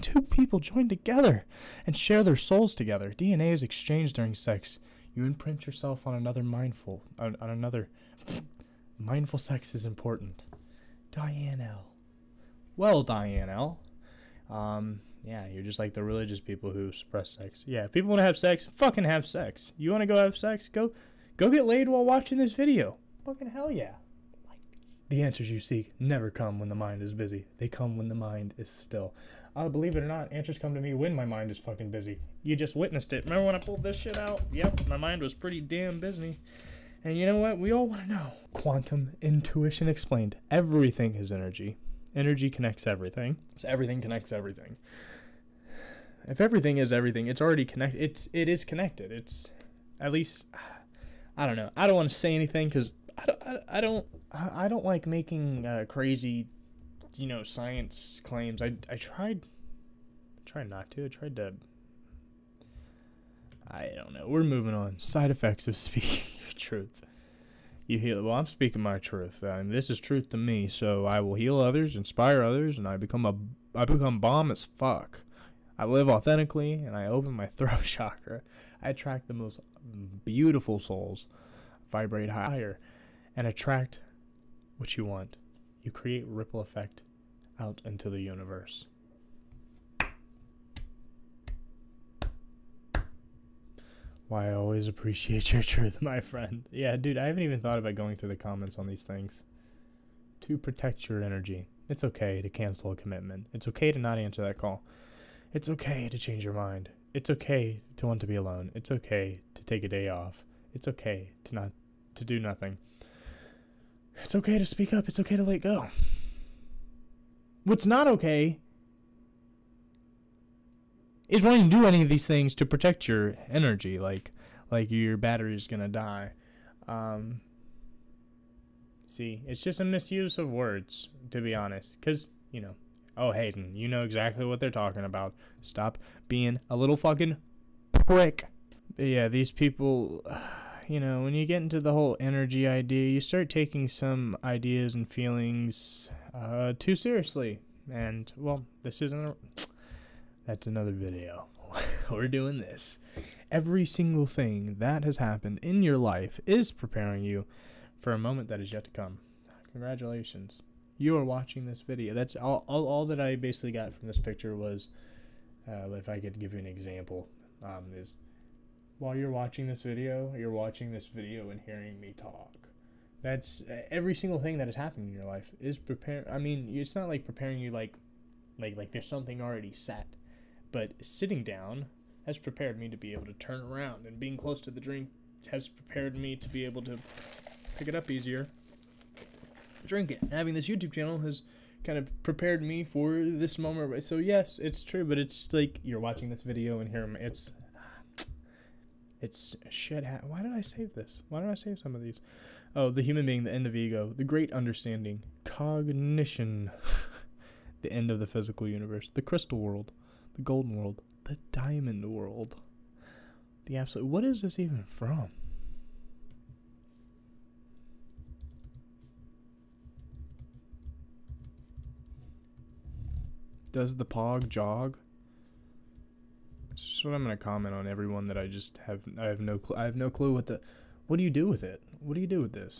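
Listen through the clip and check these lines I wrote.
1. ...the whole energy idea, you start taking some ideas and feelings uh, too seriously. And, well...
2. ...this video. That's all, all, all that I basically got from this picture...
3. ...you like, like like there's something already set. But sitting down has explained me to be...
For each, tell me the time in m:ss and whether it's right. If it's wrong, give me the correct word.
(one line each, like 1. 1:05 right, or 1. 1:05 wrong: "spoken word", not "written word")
1. 2:21 right
2. 2:41 right
3. 2:57 wrong: "prepared", not "explained".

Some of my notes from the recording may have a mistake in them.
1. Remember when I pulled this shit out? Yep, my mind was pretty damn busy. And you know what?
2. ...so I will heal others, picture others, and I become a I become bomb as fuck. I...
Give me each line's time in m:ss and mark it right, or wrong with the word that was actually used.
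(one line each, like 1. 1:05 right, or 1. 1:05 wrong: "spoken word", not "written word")
1. 0:33 right
2. 1:10 wrong: "inspire", not "picture".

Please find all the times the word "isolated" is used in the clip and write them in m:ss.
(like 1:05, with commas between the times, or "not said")
not said.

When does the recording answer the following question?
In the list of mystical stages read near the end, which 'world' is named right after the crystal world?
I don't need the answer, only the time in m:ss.
3:30.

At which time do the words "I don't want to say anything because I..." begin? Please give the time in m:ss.
0:51.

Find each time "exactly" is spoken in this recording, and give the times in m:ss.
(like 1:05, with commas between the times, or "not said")
2:14.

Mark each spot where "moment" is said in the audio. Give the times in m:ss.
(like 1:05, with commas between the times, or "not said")
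2:38, 3:13.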